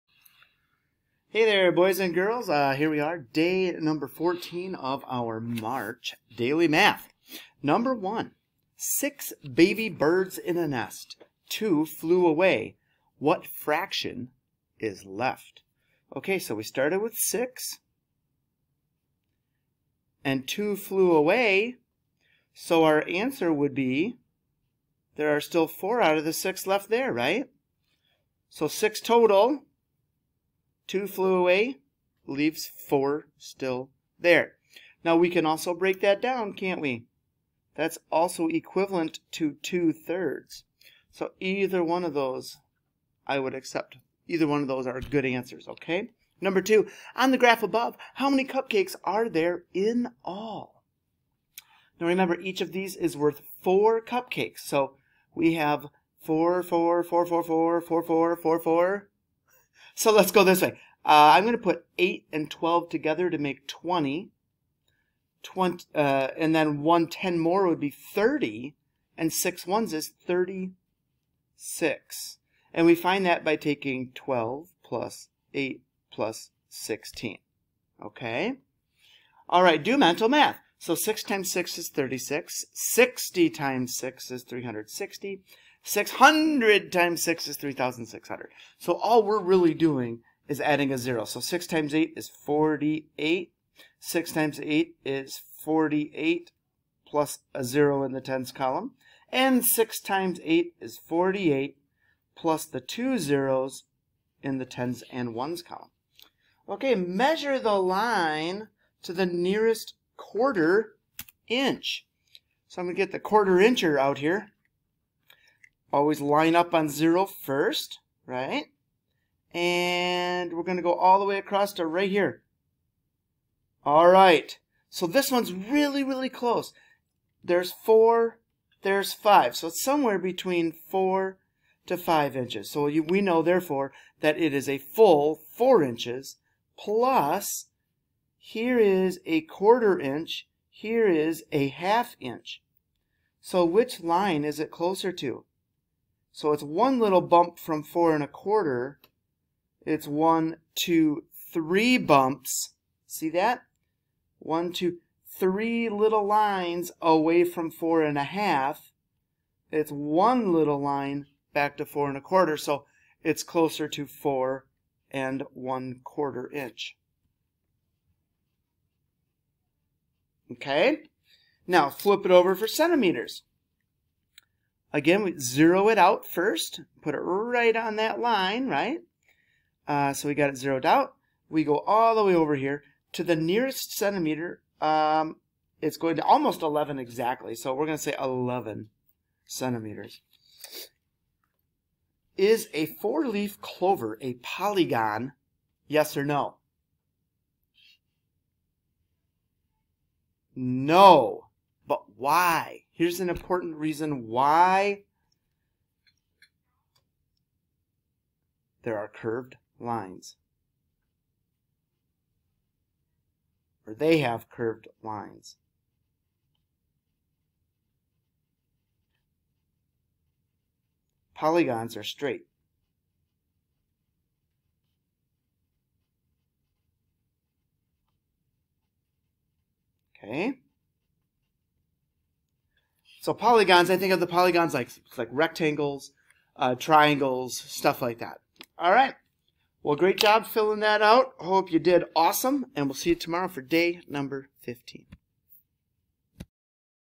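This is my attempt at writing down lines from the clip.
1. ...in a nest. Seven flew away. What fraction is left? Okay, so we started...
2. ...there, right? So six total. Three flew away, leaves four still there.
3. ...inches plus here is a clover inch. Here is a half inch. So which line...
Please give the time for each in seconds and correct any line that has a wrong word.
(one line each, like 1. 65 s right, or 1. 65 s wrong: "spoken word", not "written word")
1. 10 s wrong: "Two", not "Seven"
2. 26 s wrong: "Two", not "Three"
3. 135 s wrong: "quarter", not "clover".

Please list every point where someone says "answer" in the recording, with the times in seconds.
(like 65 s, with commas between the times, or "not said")
23 s, 45 s.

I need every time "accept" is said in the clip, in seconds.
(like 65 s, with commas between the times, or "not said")
43 s.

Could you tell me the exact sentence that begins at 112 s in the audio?
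So I'm going to get the quarter incher out here.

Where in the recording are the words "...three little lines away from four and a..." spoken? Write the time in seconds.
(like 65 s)
155 s.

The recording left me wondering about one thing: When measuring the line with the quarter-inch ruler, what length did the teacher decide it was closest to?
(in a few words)
4 1/4 inches.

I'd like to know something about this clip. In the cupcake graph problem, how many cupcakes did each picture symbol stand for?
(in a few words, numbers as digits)
4.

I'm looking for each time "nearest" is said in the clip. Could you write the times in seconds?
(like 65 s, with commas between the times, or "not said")
109 s, 183 s.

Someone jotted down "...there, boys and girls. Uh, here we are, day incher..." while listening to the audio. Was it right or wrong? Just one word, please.
wrong.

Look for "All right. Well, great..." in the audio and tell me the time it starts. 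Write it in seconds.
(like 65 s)
238 s.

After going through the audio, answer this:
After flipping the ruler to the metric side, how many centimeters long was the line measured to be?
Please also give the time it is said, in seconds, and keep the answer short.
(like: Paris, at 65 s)
11, at 188 s.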